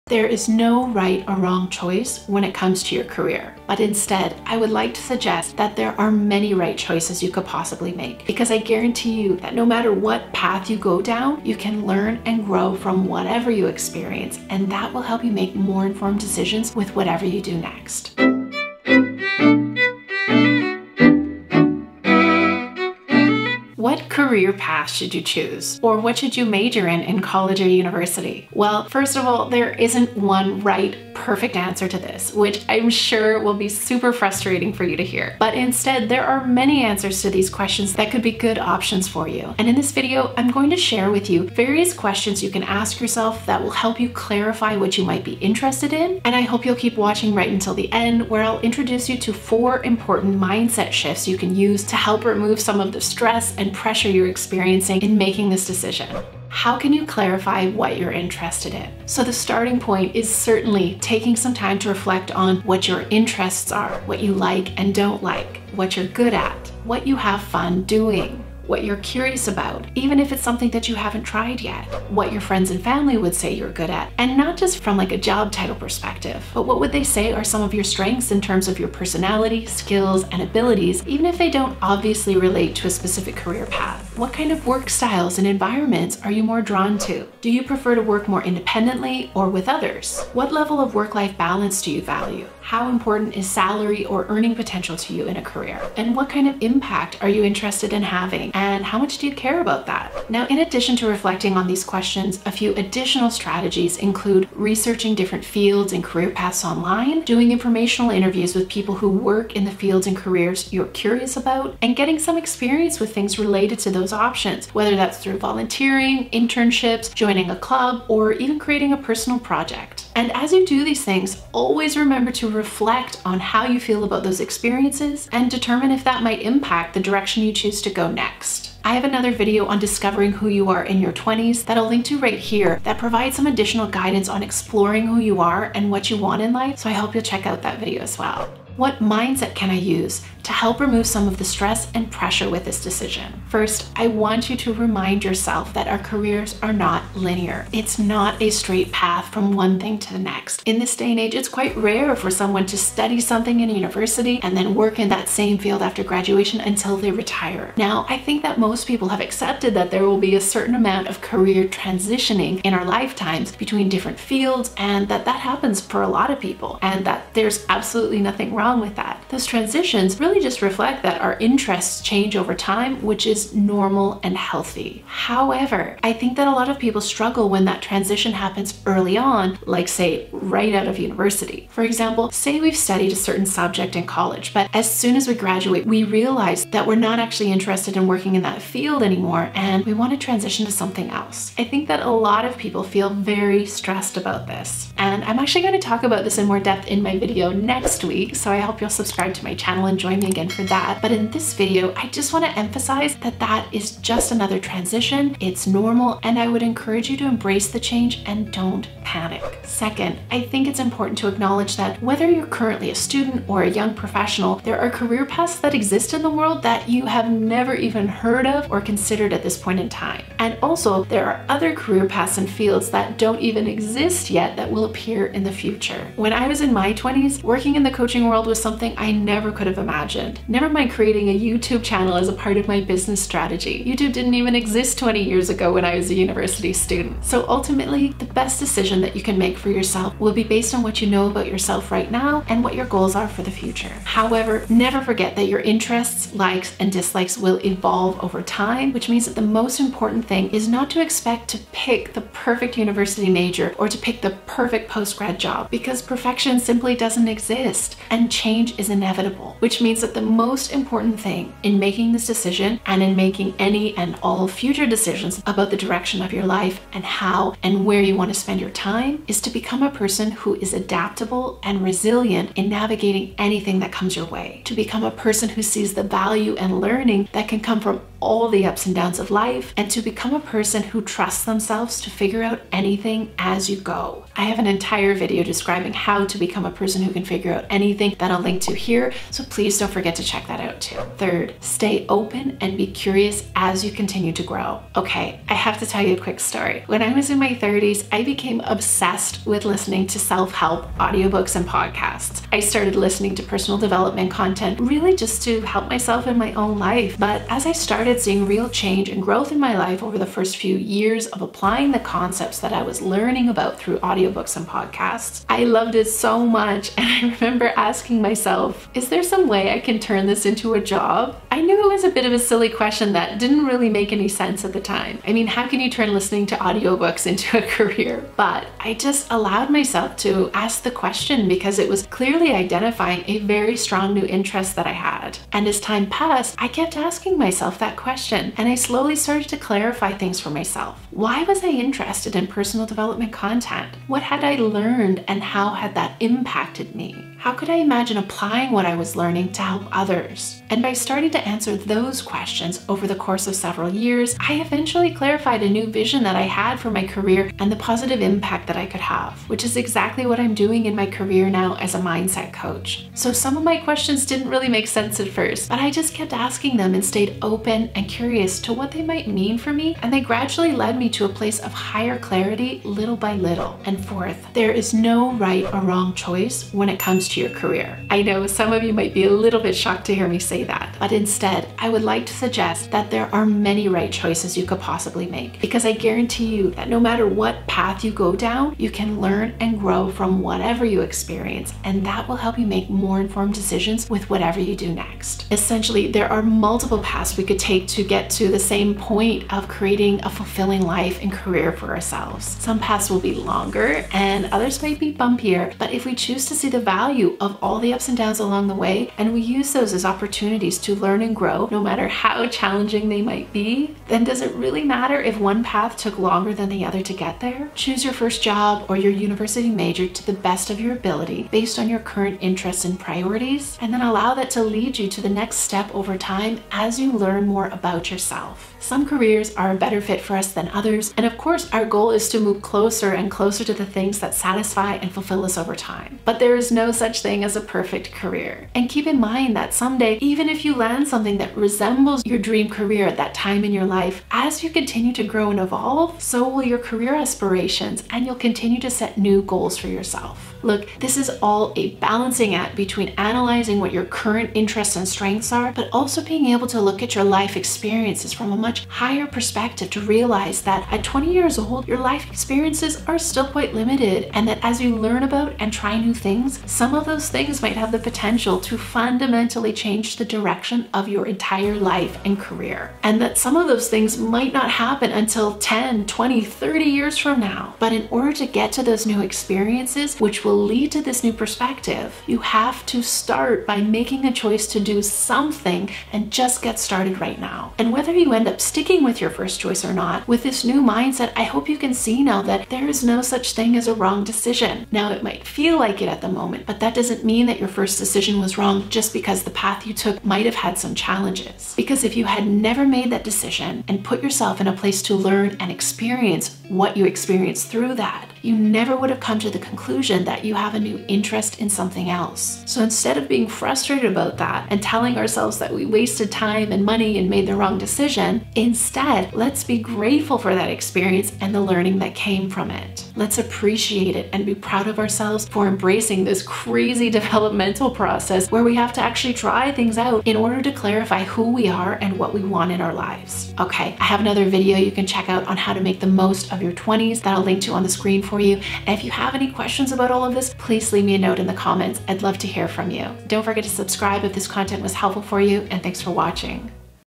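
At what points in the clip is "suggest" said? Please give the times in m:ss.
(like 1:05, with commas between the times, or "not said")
0:05, 6:22.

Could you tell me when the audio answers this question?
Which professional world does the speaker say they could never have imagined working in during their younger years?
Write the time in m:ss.
3:47.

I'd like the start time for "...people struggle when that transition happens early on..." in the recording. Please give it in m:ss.
2:56.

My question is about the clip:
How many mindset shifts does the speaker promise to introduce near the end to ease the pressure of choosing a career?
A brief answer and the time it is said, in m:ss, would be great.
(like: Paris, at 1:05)
4, at 0:49.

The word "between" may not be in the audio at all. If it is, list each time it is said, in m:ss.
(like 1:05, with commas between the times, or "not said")
2:43, 7:32.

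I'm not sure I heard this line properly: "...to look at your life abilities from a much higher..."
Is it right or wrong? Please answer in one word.
wrong.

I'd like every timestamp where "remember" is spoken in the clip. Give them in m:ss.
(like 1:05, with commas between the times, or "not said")
2:01, 5:17.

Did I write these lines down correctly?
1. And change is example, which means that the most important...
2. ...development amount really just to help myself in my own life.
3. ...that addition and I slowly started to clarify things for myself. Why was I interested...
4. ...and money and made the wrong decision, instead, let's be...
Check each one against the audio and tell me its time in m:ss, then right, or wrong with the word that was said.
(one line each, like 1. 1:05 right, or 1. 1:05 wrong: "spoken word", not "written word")
1. 4:18 wrong: "inevitable", not "example"
2. 5:03 wrong: "content", not "amount"
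3. 5:37 wrong: "question", not "addition"
4. 8:36 right.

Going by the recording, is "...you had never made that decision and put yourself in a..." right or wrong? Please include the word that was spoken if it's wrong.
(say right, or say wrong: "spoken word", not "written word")
right.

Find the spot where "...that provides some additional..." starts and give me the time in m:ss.
2:12.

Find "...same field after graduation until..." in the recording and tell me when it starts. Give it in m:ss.
2:35.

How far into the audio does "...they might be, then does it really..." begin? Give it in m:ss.
6:53.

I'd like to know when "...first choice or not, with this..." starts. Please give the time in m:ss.
8:09.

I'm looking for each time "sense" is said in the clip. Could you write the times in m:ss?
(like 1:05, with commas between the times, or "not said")
5:24, 6:04.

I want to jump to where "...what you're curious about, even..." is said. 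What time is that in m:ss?
1:08.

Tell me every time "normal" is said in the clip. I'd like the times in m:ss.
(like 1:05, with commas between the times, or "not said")
2:53, 3:25.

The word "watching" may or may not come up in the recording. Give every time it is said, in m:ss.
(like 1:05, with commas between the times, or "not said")
0:46, 9:06.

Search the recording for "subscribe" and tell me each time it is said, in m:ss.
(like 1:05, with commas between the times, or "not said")
3:18, 9:03.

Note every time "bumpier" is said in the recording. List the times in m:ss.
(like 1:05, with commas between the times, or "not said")
6:45.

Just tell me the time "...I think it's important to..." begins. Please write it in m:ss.
3:30.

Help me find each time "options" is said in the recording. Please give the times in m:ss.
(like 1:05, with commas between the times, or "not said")
0:38, 1:54.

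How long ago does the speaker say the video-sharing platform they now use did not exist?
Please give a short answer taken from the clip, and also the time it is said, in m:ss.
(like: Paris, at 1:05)
20 years ago, at 3:54.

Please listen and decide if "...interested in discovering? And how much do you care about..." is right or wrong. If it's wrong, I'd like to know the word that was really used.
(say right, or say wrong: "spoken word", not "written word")
wrong: "having", not "discovering".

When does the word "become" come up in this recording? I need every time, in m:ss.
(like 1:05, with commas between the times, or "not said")
4:29, 4:34, 4:39, 4:46.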